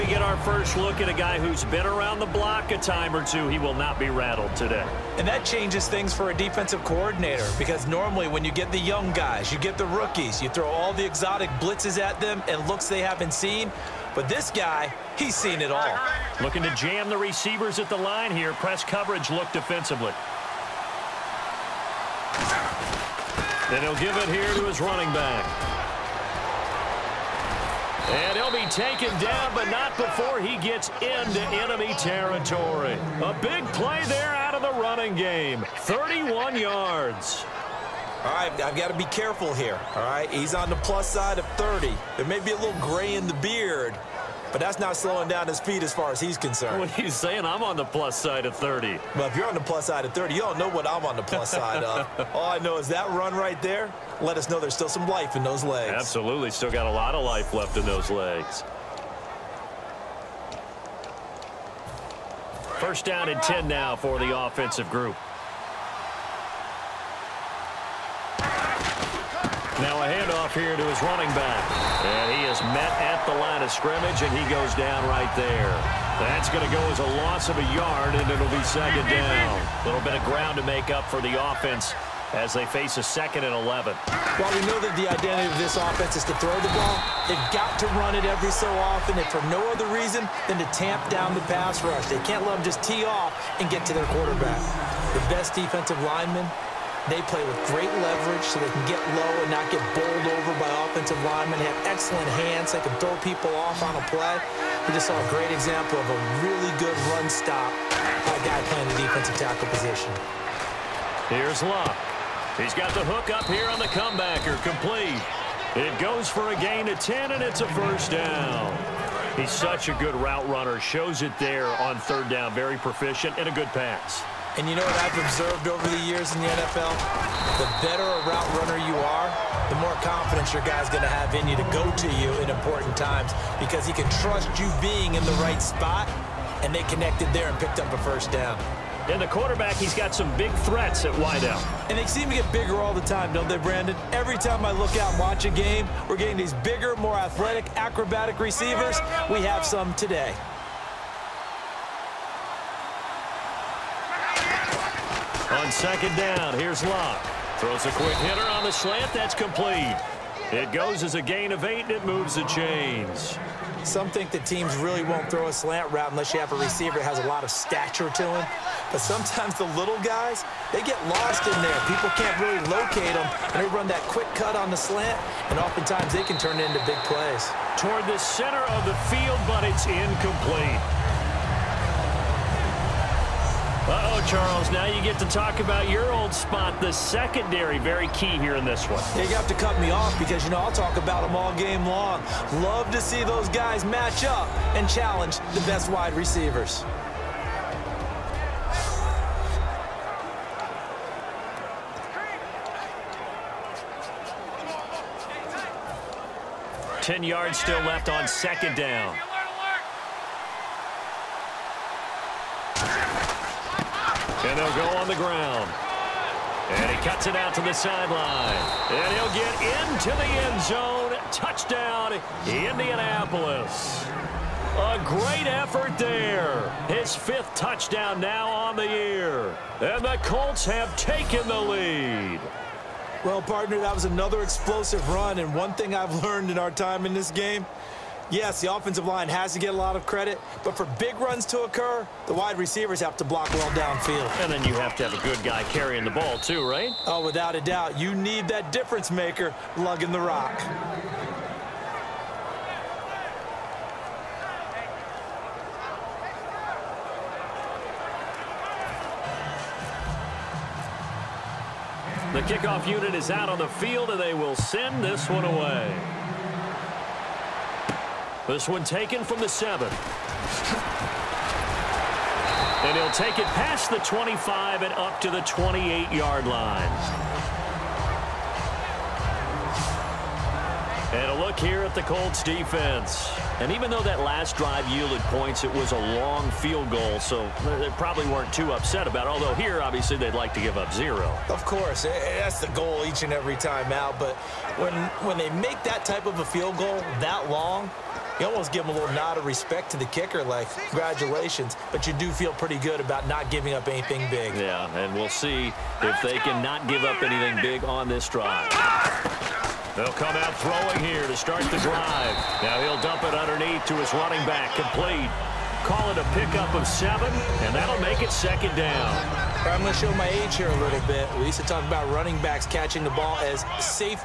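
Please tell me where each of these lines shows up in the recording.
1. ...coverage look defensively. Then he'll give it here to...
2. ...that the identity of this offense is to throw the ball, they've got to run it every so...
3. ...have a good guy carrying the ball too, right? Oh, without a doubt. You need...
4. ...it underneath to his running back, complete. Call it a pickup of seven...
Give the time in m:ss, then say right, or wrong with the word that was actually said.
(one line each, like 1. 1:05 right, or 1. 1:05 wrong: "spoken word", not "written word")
1. 0:18 right
2. 1:24 right
3. 4:05 right
4. 5:13 right.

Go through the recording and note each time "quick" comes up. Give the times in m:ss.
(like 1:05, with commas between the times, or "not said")
2:37, 2:54.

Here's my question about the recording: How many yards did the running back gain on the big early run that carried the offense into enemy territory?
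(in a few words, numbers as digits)
31.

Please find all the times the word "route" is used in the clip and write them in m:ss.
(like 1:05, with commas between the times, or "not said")
2:00, 2:08, 2:45.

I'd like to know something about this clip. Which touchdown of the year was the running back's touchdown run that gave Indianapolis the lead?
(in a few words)
fifth.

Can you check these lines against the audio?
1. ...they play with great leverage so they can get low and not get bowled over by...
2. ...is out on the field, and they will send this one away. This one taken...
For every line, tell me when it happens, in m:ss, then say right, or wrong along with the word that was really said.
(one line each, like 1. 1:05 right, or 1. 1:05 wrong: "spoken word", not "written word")
1. 1:37 right
2. 4:23 right.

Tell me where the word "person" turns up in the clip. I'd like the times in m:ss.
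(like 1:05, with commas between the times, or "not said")
not said.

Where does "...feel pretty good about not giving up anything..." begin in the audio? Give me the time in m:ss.
5:02.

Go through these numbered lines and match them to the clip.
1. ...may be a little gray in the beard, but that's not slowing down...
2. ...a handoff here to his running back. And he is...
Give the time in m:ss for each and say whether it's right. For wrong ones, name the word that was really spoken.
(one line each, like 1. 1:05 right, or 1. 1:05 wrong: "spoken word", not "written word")
1. 0:42 right
2. 1:10 right.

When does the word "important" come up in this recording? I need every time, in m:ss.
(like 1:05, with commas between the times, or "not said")
2:12.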